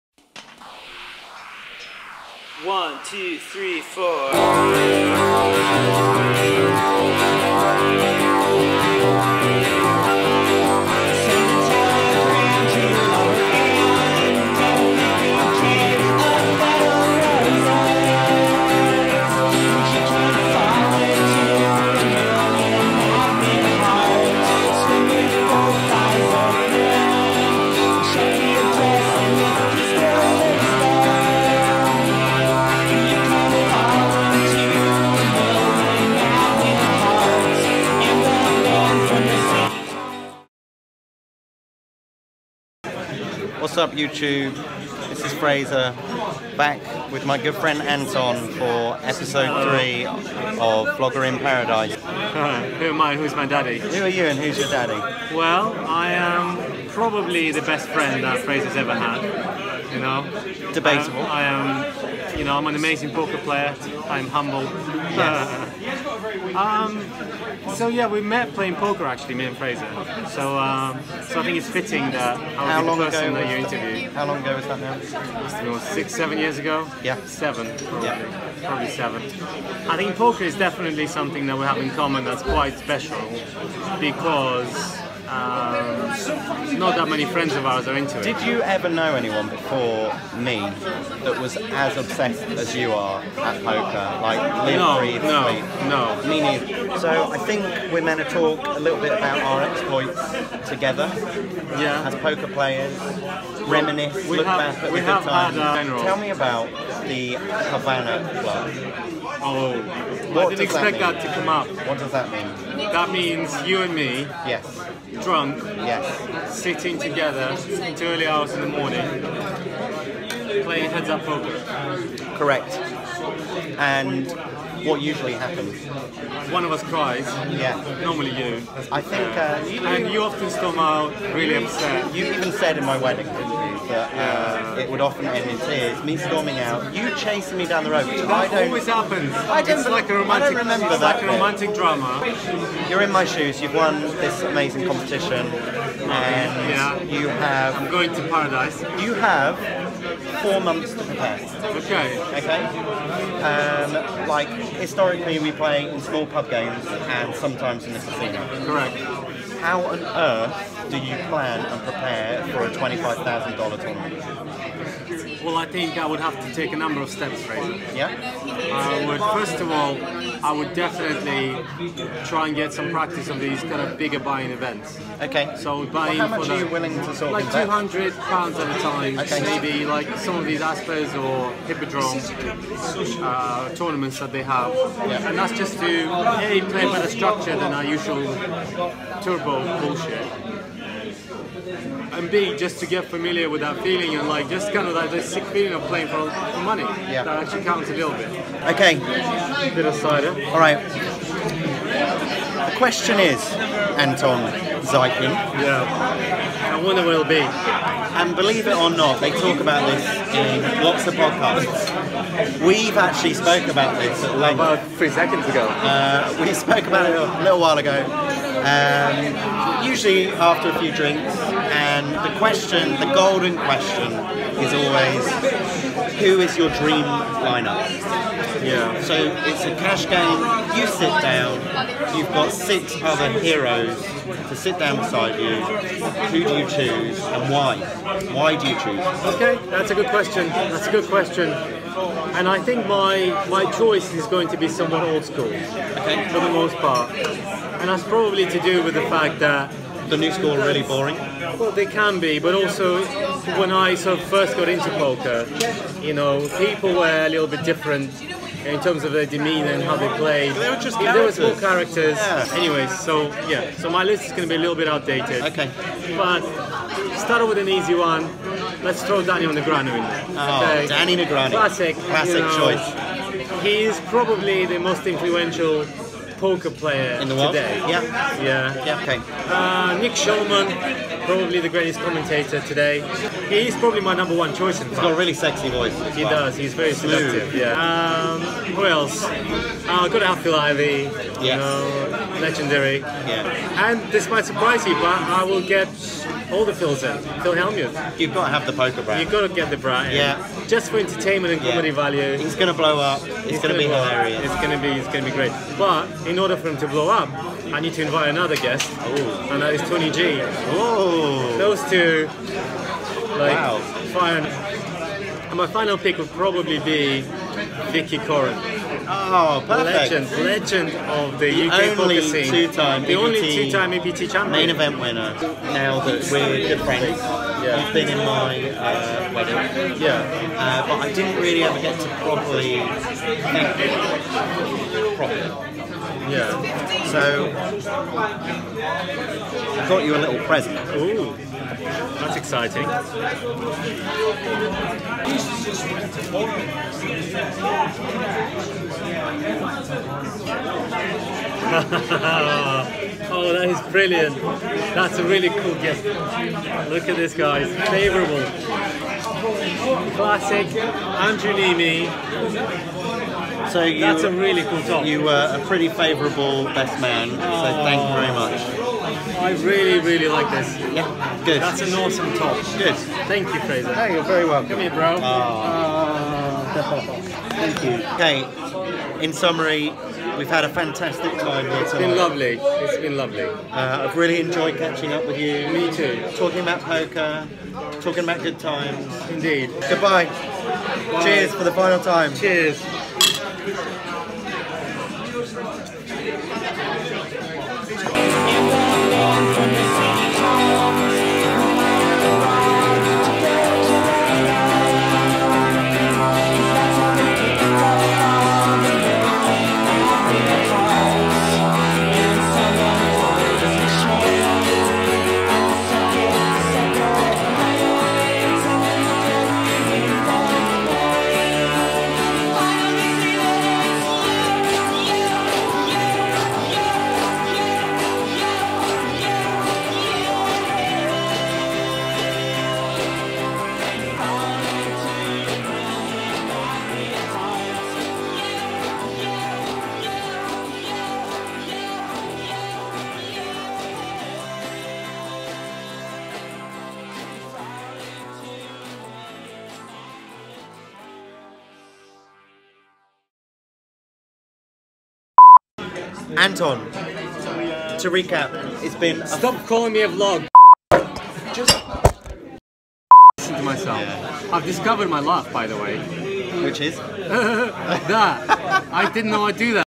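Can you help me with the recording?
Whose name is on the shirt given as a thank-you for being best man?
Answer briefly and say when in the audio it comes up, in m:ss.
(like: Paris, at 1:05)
Andrew Neeme, at 6:00.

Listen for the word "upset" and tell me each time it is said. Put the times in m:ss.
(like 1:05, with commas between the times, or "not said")
2:11.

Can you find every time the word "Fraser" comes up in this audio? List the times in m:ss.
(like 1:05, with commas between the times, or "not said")
0:45, 0:58, 1:09, 2:47, 6:13.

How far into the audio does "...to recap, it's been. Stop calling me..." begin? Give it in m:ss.
7:37.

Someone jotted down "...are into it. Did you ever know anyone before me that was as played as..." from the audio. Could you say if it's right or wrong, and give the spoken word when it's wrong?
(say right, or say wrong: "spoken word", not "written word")
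wrong: "obsessed", not "played".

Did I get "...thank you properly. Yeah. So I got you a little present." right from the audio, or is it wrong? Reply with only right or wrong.
right.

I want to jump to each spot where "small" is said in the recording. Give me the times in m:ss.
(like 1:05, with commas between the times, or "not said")
2:35, 4:21.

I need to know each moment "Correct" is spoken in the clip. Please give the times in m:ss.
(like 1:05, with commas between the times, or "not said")
2:02, 2:38.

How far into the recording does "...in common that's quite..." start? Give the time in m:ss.
1:21.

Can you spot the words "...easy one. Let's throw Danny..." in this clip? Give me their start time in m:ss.
4:27.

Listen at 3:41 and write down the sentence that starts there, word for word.
And the question, the golden question, is always who is your dream lineup?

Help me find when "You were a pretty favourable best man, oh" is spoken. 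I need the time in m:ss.
6:05.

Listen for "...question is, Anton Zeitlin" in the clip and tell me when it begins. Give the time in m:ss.
3:22.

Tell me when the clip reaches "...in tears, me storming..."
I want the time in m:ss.
2:15.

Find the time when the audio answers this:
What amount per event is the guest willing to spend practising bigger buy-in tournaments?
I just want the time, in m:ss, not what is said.
2:57.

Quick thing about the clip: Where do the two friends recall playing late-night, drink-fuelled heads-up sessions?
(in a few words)
Havana Club.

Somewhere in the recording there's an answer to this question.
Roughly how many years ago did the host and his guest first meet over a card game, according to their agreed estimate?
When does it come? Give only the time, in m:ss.
1:17.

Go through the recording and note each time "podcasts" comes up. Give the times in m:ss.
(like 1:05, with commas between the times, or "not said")
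3:31.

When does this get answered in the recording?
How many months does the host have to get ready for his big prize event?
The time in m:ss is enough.
2:30.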